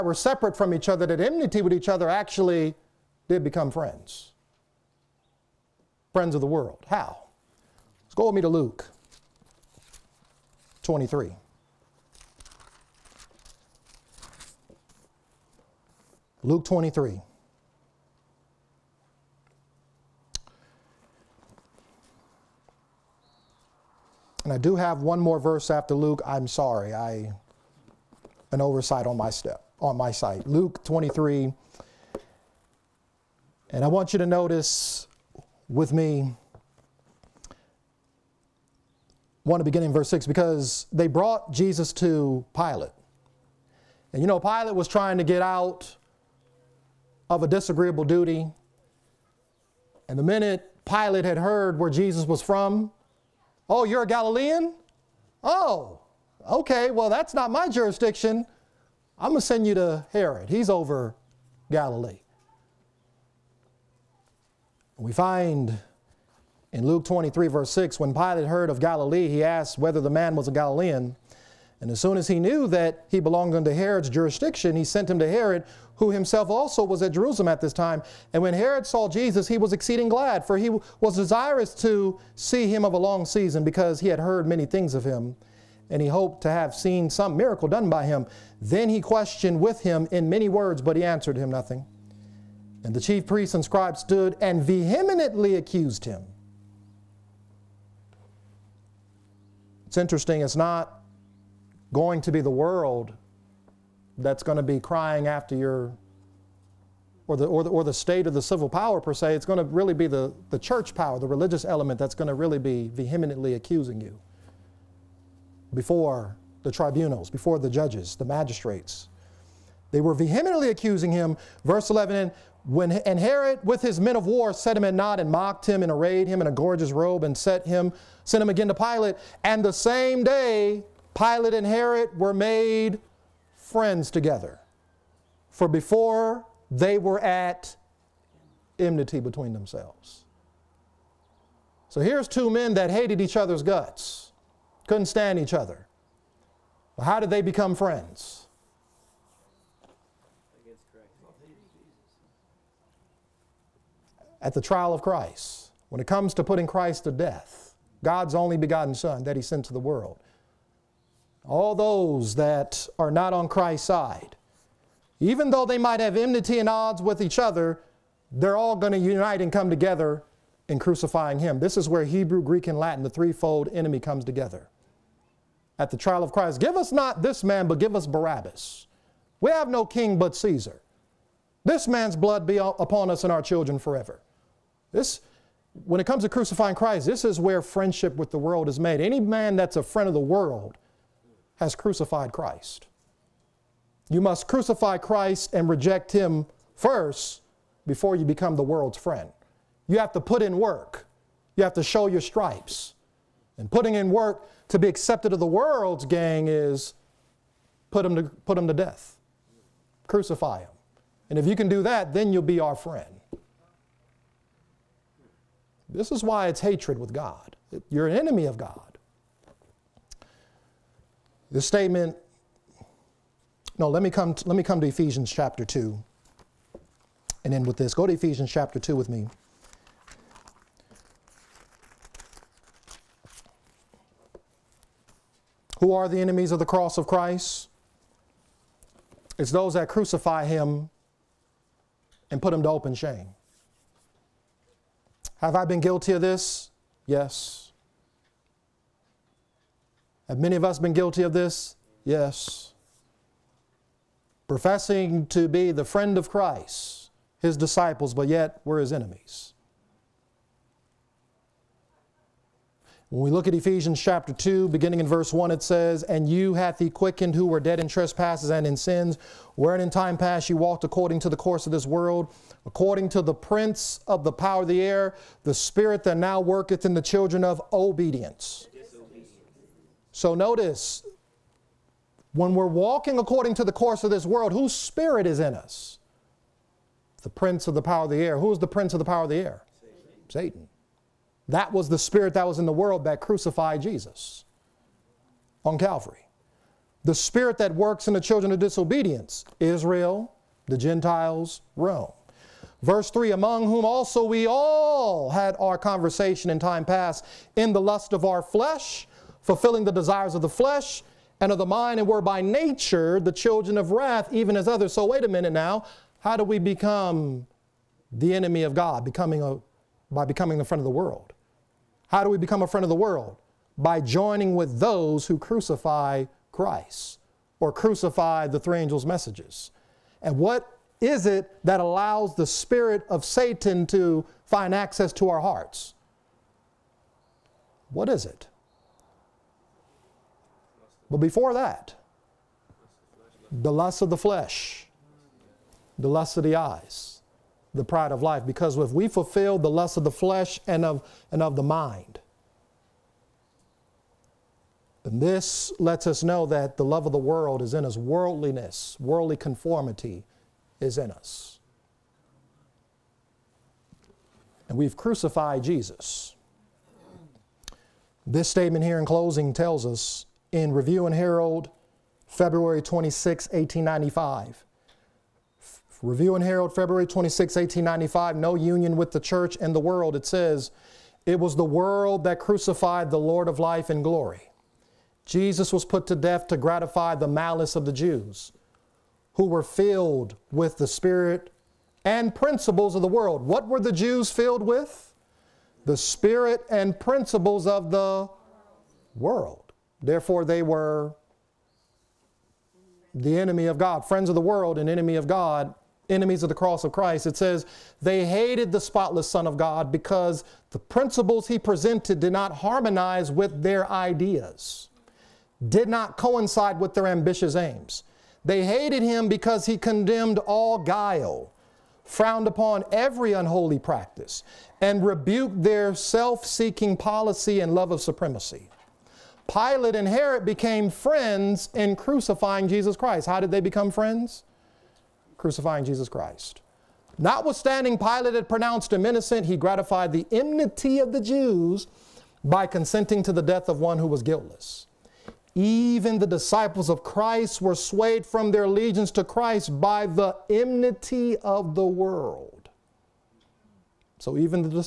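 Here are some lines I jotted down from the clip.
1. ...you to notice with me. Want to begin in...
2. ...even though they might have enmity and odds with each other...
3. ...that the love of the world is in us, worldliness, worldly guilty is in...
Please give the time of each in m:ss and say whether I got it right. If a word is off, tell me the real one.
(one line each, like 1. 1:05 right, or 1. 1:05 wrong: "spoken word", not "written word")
1. 0:34 right
2. 2:45 right
3. 5:56 wrong: "conformity", not "guilty".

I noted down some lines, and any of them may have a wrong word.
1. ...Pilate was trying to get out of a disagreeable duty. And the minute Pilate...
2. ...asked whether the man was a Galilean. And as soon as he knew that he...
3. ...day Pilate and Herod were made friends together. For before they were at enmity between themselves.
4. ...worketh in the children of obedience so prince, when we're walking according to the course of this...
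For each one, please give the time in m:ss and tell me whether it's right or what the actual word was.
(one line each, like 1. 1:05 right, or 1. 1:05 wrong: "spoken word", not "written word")
1. 0:44 right
2. 1:09 right
3. 2:10 right
4. 4:36 wrong: "notice", not "prince".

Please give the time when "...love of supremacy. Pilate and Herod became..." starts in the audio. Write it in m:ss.
7:07.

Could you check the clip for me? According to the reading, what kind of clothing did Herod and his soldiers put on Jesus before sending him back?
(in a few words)
A gorgeous robe.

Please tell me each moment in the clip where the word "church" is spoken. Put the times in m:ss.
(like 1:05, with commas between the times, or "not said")
1:50, 6:19.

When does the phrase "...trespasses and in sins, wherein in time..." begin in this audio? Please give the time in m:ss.
4:27.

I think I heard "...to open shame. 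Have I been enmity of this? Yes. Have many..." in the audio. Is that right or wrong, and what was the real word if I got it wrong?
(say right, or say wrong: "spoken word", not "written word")
wrong: "guilty", not "enmity".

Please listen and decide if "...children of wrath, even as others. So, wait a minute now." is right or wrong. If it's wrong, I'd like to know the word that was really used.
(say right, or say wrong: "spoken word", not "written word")
right.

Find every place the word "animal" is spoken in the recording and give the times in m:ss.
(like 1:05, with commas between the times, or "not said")
not said.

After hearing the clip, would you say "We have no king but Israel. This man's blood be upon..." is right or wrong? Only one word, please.
wrong.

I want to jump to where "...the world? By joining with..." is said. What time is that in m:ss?
5:22.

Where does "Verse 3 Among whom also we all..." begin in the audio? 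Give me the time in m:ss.
5:02.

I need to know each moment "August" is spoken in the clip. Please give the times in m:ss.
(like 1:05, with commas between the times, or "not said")
not said.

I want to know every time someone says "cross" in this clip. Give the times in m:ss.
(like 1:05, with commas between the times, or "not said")
3:56, 6:46.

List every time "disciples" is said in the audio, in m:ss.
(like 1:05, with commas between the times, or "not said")
4:17, 7:26.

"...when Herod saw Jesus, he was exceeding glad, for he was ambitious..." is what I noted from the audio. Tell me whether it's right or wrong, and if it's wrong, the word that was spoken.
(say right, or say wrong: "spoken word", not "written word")
wrong: "desirous", not "ambitious".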